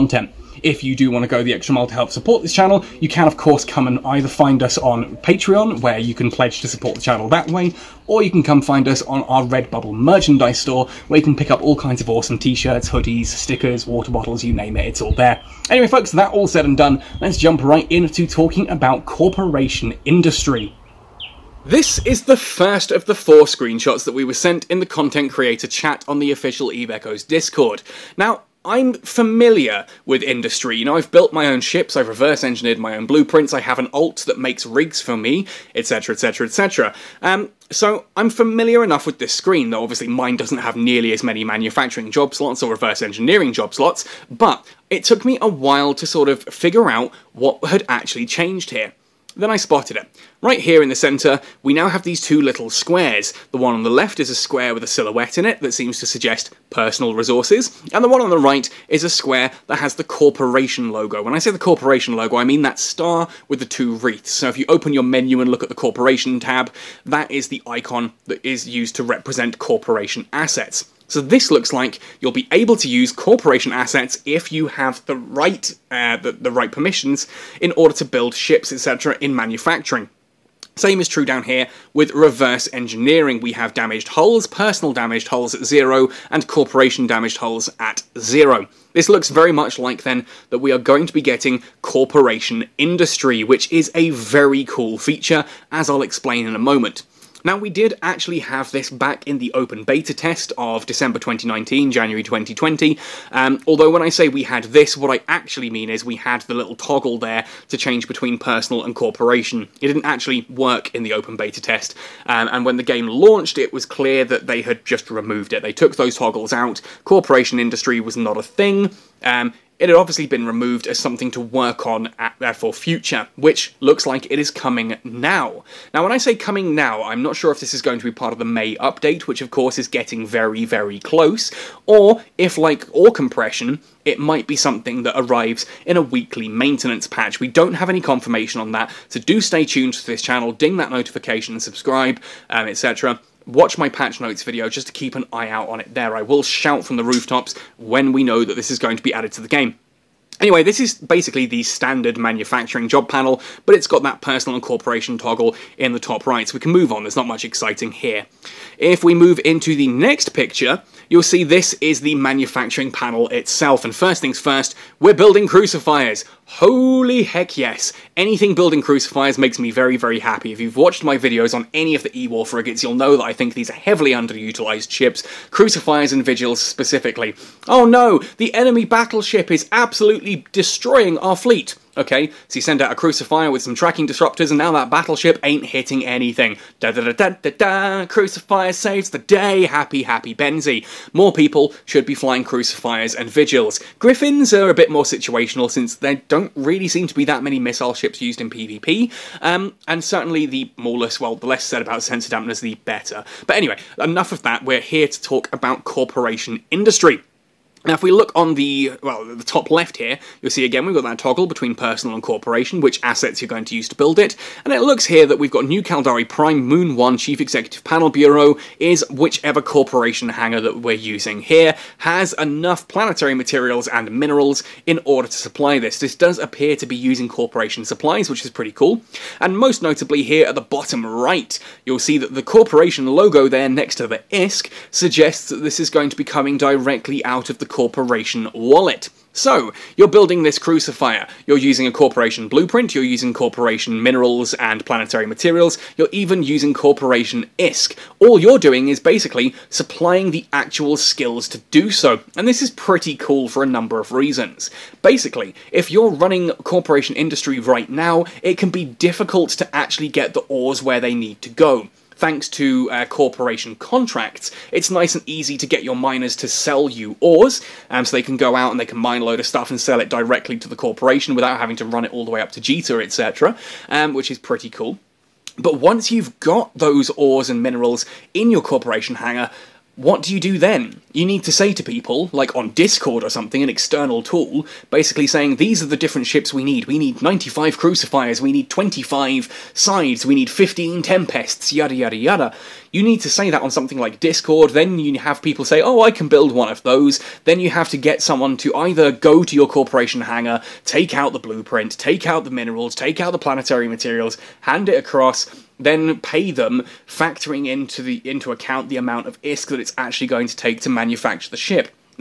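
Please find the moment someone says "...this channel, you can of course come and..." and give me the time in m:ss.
0:02.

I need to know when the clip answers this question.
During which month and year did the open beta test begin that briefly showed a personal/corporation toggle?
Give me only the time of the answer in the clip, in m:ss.
1:40.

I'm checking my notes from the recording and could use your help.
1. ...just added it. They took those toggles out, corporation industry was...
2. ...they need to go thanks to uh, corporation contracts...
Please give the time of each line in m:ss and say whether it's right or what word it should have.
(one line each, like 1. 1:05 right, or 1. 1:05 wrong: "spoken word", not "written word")
1. 1:54 wrong: "removed", not "added"
2. 4:20 right.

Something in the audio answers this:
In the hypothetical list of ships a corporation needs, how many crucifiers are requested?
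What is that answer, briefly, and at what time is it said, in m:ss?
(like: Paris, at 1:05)
95, at 4:47.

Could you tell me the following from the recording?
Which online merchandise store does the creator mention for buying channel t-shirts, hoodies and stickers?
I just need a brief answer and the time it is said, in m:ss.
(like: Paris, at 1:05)
Redbubble, at 0:09.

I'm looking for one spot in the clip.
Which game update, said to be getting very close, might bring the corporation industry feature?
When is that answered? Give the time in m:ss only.
2:08.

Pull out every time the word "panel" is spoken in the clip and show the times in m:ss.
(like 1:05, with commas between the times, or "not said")
2:33, 2:42, 3:37.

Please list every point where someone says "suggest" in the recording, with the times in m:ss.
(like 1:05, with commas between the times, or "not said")
0:56, 3:54.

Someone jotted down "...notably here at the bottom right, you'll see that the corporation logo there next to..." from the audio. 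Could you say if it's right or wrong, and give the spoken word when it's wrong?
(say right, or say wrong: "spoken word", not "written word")
right.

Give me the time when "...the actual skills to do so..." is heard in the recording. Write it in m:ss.
4:10.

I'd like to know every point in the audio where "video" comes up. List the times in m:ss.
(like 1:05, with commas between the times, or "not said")
2:24, 2:51.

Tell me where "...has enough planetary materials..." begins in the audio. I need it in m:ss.
3:41.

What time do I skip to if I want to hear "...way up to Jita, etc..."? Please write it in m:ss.
4:32.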